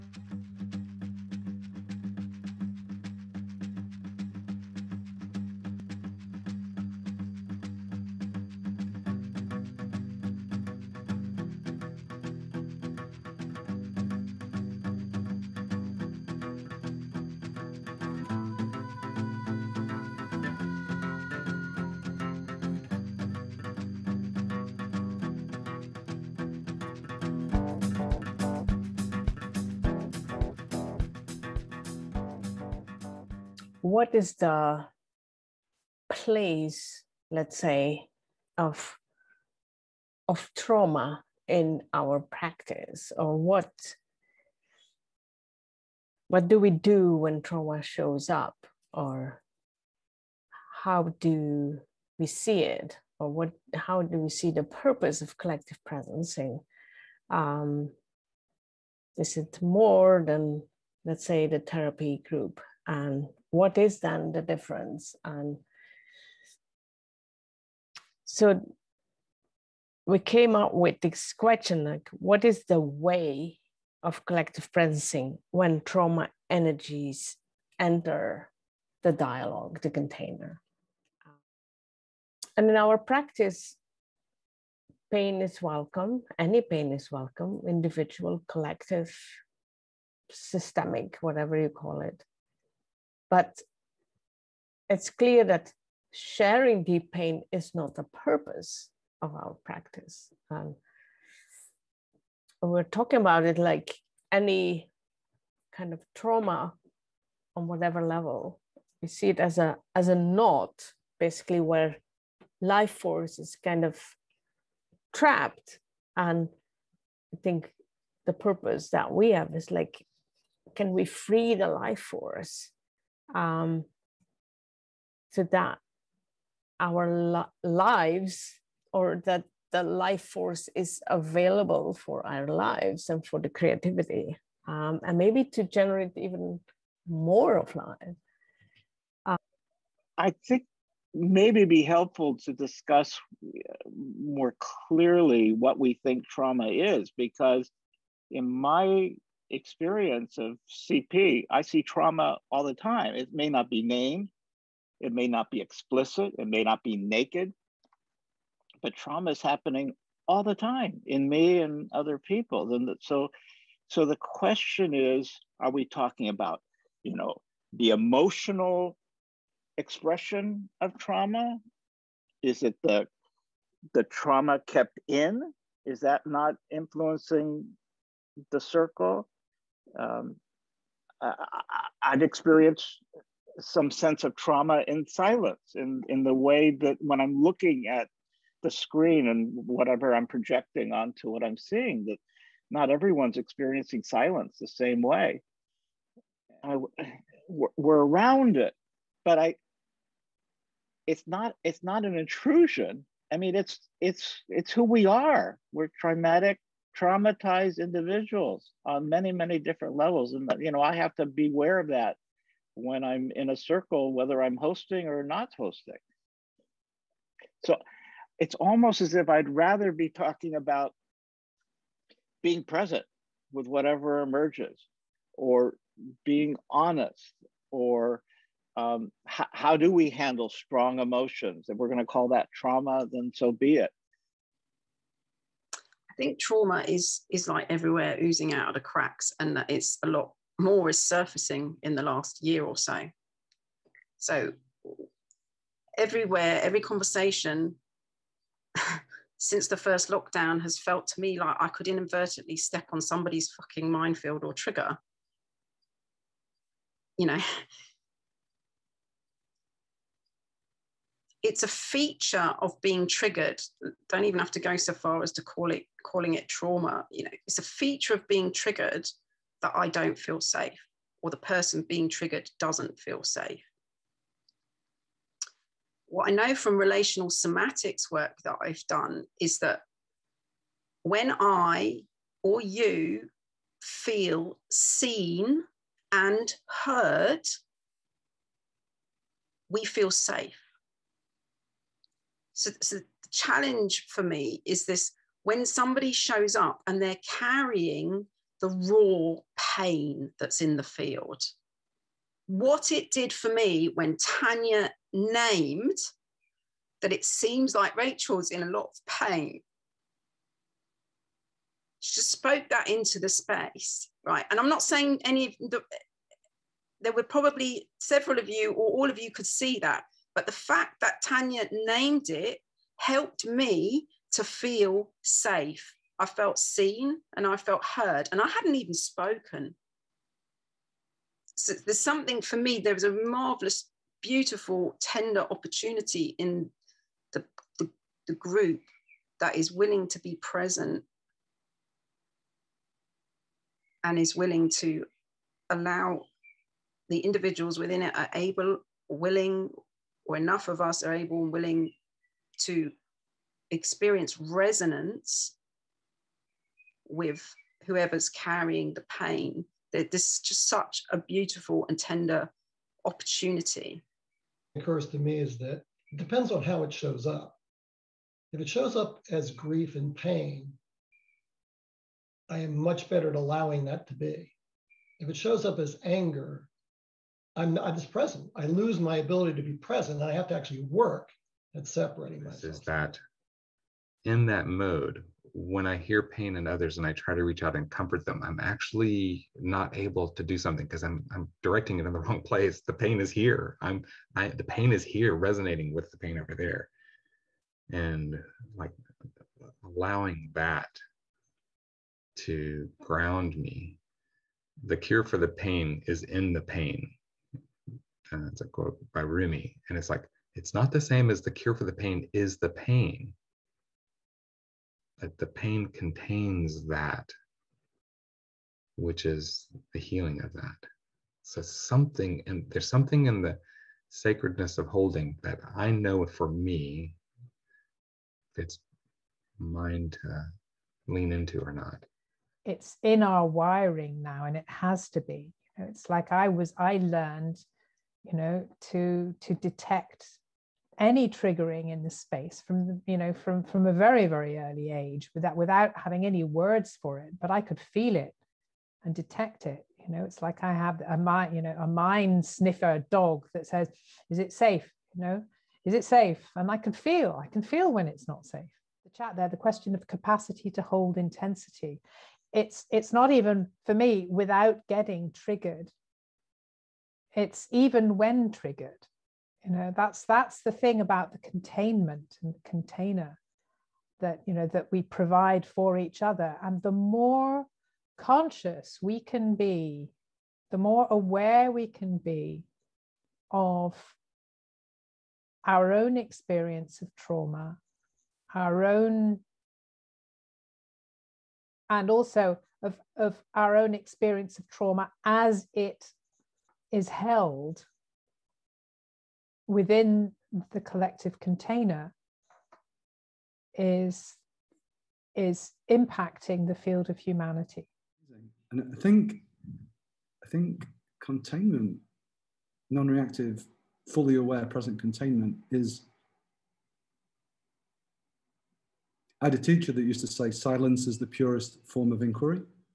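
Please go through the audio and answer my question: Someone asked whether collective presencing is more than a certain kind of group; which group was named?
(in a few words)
the therapy group.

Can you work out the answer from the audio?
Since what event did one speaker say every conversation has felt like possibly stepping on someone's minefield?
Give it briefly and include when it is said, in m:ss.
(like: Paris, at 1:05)
the first lockdown, at 4:09.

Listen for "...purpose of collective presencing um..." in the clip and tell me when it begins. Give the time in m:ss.
0:54.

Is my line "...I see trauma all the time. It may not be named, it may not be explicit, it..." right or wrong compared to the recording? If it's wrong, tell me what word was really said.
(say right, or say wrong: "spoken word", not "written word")
right.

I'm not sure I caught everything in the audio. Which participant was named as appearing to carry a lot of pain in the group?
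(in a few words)
Rachel.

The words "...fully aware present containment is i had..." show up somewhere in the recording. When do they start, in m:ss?
8:34.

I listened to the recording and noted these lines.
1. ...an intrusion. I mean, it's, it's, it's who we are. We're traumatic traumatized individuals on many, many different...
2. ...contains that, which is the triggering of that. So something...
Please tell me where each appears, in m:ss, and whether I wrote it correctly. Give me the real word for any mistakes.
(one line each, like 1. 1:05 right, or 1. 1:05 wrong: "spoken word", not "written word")
1. 3:22 right
2. 6:55 wrong: "healing", not "triggering".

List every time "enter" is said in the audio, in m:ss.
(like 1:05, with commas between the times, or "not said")
1:17.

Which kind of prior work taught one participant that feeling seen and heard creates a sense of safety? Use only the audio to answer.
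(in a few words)
relational somatics.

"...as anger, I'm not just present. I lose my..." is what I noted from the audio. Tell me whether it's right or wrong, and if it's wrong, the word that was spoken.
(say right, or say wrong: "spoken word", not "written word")
right.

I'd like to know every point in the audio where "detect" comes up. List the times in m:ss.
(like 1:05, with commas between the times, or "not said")
7:19, 7:29.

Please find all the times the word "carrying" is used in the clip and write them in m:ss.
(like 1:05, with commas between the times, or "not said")
4:57, 5:58.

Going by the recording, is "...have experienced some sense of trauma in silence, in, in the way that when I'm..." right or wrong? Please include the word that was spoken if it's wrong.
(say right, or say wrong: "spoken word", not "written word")
right.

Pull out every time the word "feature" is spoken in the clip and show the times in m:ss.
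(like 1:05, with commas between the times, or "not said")
4:21, 4:27.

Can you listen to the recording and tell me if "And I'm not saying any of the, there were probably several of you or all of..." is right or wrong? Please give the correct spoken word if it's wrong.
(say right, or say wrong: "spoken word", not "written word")
right.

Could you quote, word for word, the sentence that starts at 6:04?
It occurs to me is that it depends on how it shows up.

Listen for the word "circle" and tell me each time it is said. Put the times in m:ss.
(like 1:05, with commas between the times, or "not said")
2:58, 3:33.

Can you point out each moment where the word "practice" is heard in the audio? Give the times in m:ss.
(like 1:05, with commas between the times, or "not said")
0:42, 1:22, 1:39.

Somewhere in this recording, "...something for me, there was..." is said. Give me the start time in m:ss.
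5:31.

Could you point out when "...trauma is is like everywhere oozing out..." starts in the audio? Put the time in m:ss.
3:56.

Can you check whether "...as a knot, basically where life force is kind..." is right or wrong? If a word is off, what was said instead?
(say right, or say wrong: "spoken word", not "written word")
right.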